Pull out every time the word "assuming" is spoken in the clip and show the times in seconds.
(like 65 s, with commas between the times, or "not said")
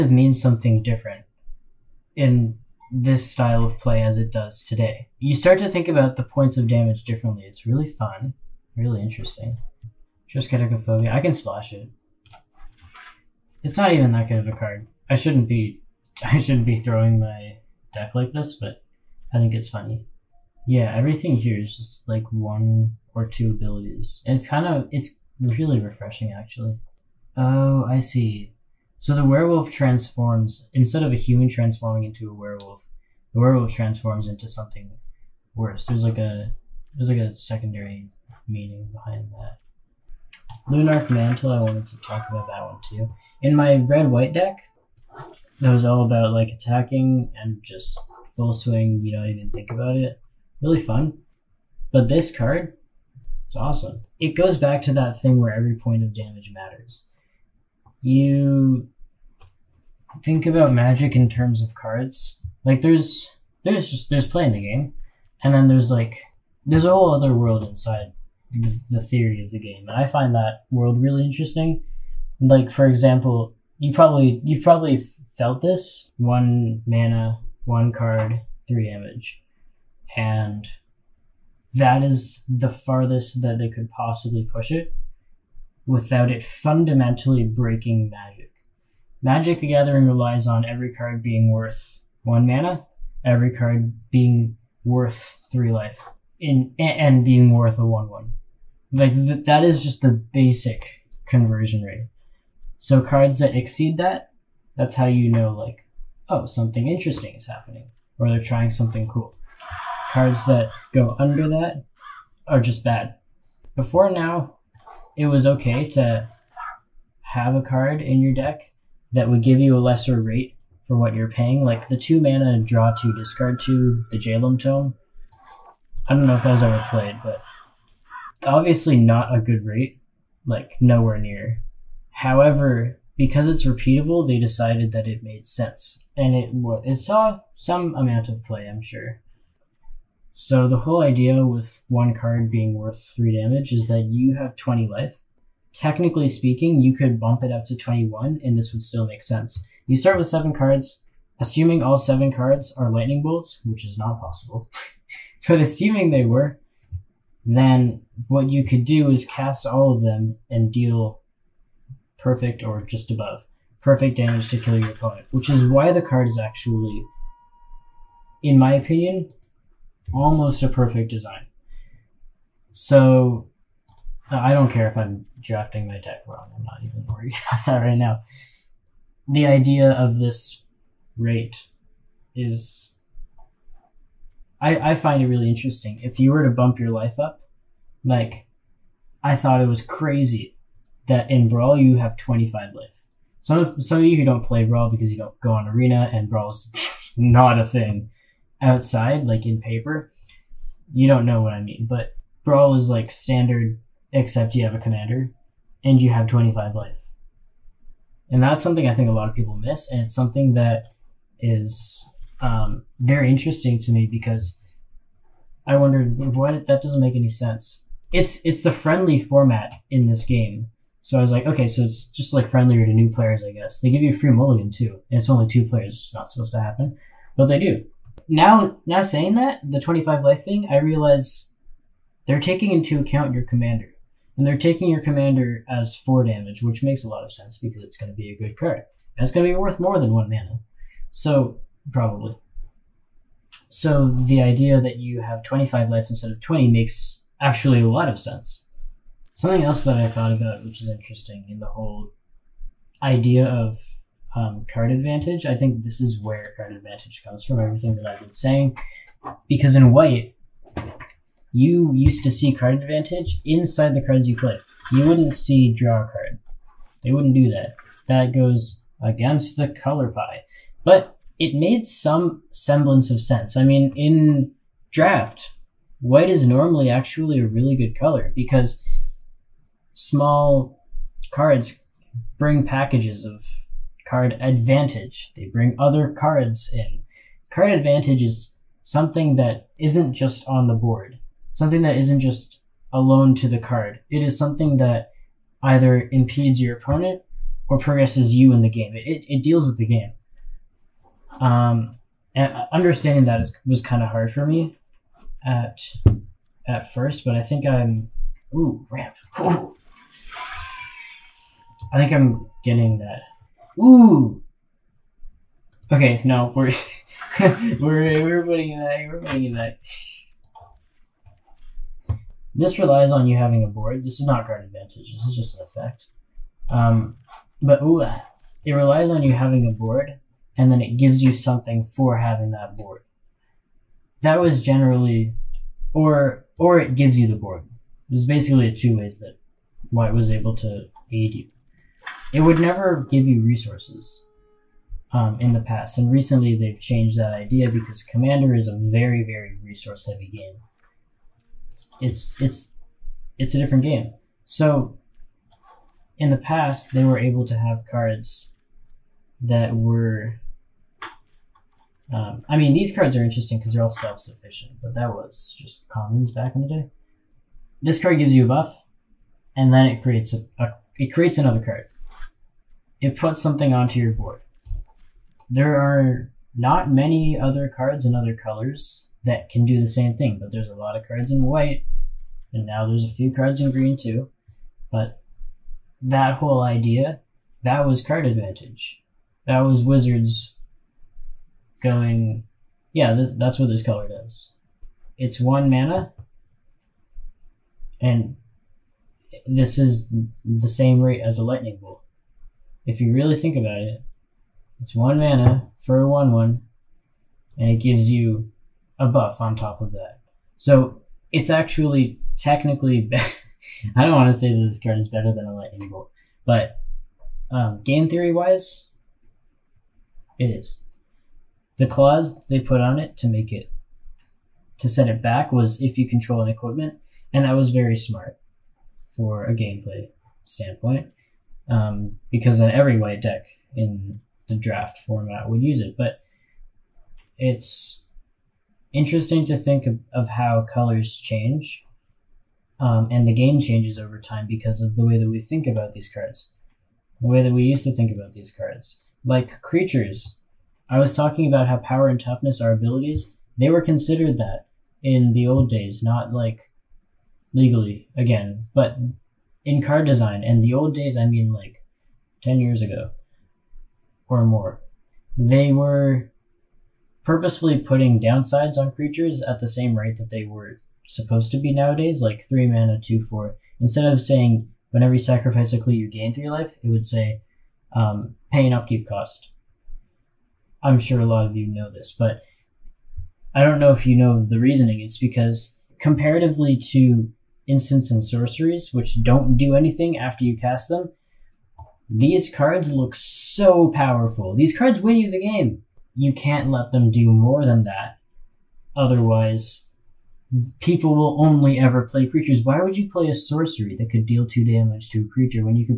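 151 s, 155 s.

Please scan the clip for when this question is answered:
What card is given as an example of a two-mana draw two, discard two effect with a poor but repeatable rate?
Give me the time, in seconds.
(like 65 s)
124 s.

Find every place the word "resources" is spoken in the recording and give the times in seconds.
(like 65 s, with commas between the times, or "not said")
343 s, 349 s.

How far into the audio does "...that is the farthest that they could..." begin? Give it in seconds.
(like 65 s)
81 s.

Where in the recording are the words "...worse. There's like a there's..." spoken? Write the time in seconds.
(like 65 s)
35 s.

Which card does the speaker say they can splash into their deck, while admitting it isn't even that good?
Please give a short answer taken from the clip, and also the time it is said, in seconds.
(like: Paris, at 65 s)
Phobia, at 10 s.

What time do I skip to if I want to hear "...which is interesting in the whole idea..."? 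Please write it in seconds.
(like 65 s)
250 s.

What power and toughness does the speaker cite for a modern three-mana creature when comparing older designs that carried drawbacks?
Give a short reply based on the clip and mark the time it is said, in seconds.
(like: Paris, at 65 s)
2/4, at 473 s.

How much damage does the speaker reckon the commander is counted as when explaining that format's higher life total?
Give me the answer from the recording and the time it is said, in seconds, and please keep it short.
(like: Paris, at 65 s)
4, at 235 s.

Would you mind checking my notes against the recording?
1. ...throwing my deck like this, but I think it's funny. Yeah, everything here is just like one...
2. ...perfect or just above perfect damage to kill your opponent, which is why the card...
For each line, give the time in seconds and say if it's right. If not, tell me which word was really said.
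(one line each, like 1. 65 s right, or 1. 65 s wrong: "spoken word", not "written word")
1. 16 s right
2. 162 s right.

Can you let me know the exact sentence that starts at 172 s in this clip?
So I don't care if I'm drafting my deck wrong.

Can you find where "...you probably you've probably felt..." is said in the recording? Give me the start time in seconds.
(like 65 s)
73 s.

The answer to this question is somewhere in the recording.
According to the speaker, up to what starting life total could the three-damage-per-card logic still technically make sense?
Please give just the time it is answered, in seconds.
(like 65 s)
147 s.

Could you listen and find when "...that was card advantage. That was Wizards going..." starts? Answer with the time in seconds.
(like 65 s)
387 s.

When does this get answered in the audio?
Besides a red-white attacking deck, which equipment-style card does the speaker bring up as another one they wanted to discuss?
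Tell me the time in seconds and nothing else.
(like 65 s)
40 s.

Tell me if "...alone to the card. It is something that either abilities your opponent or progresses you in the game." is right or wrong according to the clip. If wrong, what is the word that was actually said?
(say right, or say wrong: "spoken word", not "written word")
wrong: "impedes", not "abilities".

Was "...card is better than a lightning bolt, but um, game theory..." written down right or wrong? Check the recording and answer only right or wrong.
right.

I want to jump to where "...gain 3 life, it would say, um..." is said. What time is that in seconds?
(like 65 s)
476 s.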